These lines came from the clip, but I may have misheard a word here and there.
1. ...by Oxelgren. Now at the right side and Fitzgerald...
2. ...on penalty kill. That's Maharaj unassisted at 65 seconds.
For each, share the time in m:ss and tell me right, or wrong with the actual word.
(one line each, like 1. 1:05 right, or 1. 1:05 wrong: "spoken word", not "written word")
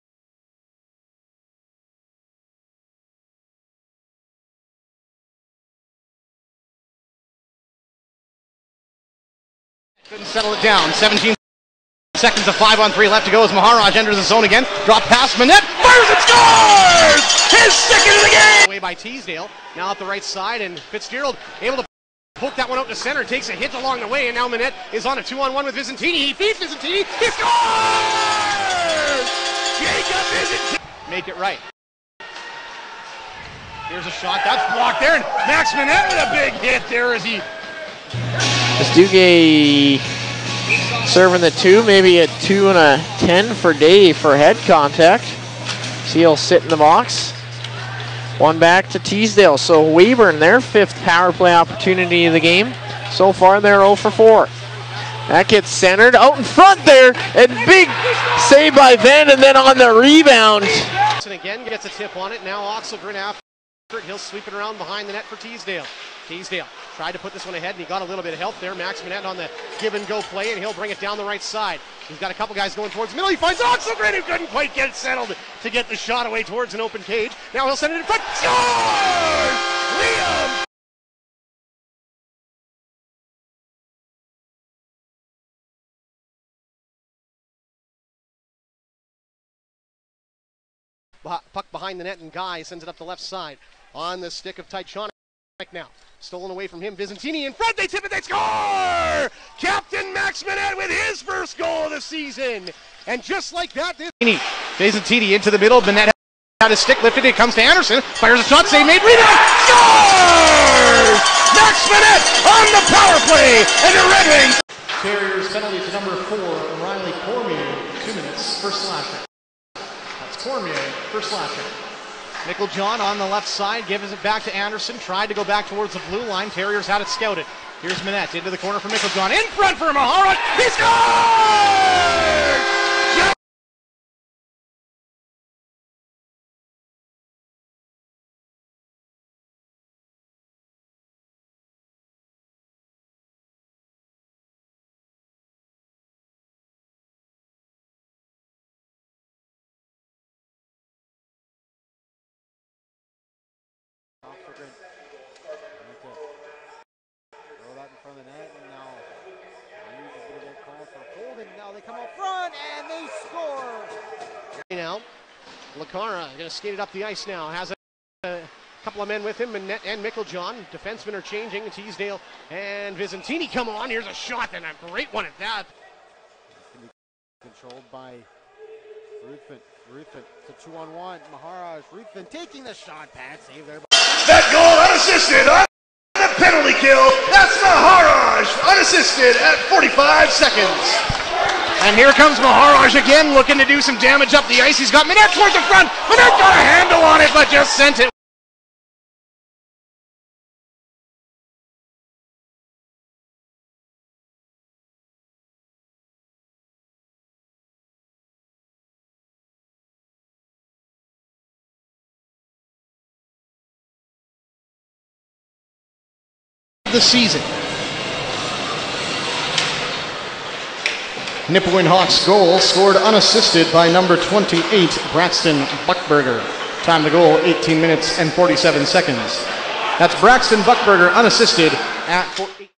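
1. 0:18 wrong: "Teasdale", not "Oxelgren"
2. 3:05 wrong: "45", not "65".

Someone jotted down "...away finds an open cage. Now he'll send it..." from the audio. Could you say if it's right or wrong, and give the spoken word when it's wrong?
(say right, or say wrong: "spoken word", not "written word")
wrong: "towards", not "finds".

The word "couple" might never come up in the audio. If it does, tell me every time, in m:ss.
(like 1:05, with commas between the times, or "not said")
1:12, 2:48.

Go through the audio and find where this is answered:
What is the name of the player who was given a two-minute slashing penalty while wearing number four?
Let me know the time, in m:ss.
1:56.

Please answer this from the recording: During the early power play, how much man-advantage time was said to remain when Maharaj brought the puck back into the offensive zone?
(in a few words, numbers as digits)
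17 seconds.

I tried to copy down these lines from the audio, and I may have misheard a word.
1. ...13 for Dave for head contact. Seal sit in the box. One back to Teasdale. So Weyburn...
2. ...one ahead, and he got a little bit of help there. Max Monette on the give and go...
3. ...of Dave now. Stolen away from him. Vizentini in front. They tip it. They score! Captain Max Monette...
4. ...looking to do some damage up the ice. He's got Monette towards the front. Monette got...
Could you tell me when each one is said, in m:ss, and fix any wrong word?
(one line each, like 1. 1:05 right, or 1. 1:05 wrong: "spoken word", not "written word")
1. 0:43 wrong: "10", not "13"
2. 1:07 right
3. 1:34 wrong: "Tychon", not "Dave"
4. 3:13 right.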